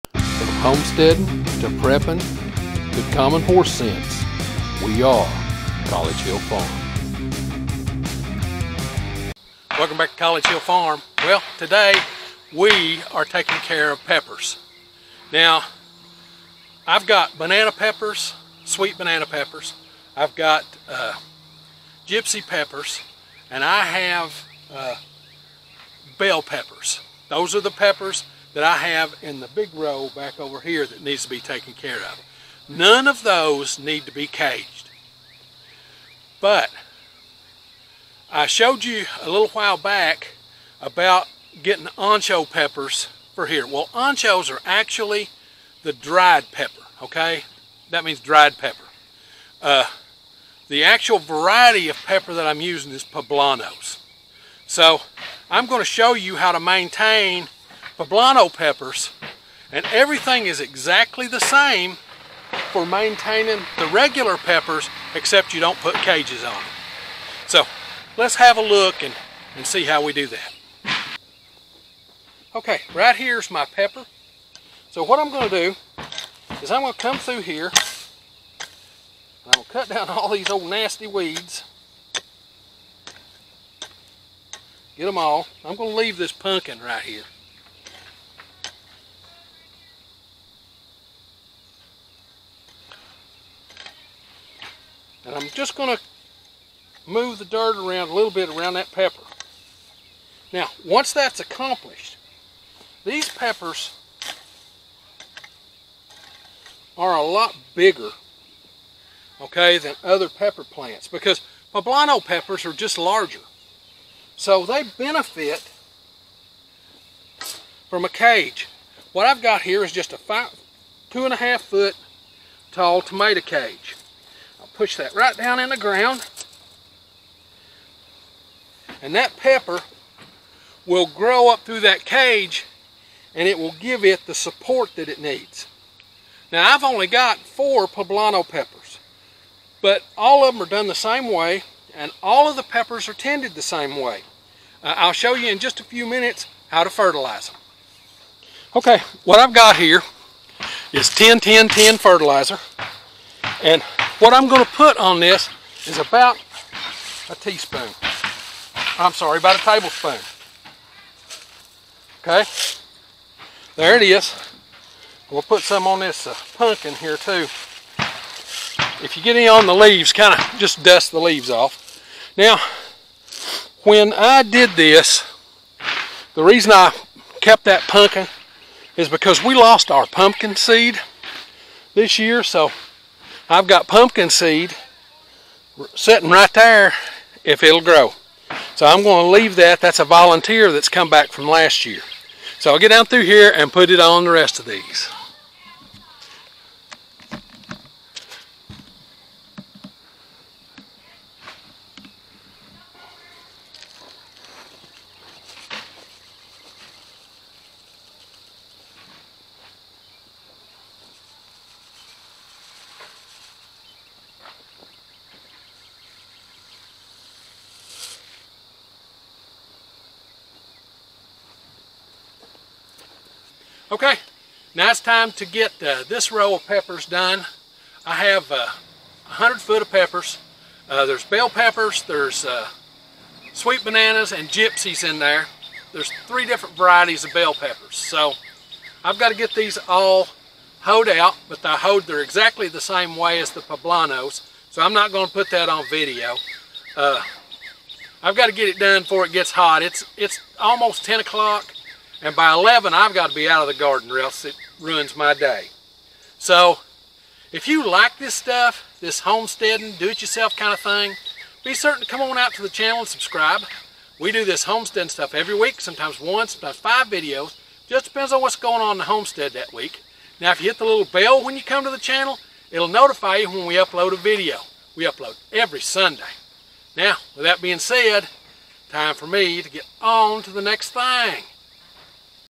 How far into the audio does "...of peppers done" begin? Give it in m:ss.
3:46.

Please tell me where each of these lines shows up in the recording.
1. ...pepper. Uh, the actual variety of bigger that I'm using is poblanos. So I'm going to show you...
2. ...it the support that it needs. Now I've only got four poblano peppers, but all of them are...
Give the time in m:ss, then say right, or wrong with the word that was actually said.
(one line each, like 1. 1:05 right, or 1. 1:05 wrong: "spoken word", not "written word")
1. 0:48 wrong: "pepper", not "bigger"
2. 2:14 right.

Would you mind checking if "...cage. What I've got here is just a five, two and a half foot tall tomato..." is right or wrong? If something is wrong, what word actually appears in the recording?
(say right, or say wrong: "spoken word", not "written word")
right.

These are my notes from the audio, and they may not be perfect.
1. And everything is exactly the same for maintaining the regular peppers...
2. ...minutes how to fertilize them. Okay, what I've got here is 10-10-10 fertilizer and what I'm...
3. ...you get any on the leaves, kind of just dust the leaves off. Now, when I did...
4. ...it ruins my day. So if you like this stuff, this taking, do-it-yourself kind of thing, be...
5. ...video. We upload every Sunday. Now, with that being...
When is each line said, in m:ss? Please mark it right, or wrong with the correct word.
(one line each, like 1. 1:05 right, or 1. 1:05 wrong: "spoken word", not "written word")
1. 0:59 right
2. 2:26 right
3. 2:49 right
4. 4:14 wrong: "homesteading", not "taking"
5. 4:34 right.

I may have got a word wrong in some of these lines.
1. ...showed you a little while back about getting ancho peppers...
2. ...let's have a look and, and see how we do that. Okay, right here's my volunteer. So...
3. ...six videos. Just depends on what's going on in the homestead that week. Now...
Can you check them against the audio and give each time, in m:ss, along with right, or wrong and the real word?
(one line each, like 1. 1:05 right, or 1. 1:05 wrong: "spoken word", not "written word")
1. 0:38 right
2. 1:08 wrong: "pepper", not "volunteer"
3. 4:26 wrong: "five", not "six".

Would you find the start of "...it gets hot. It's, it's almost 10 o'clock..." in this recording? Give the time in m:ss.
4:09.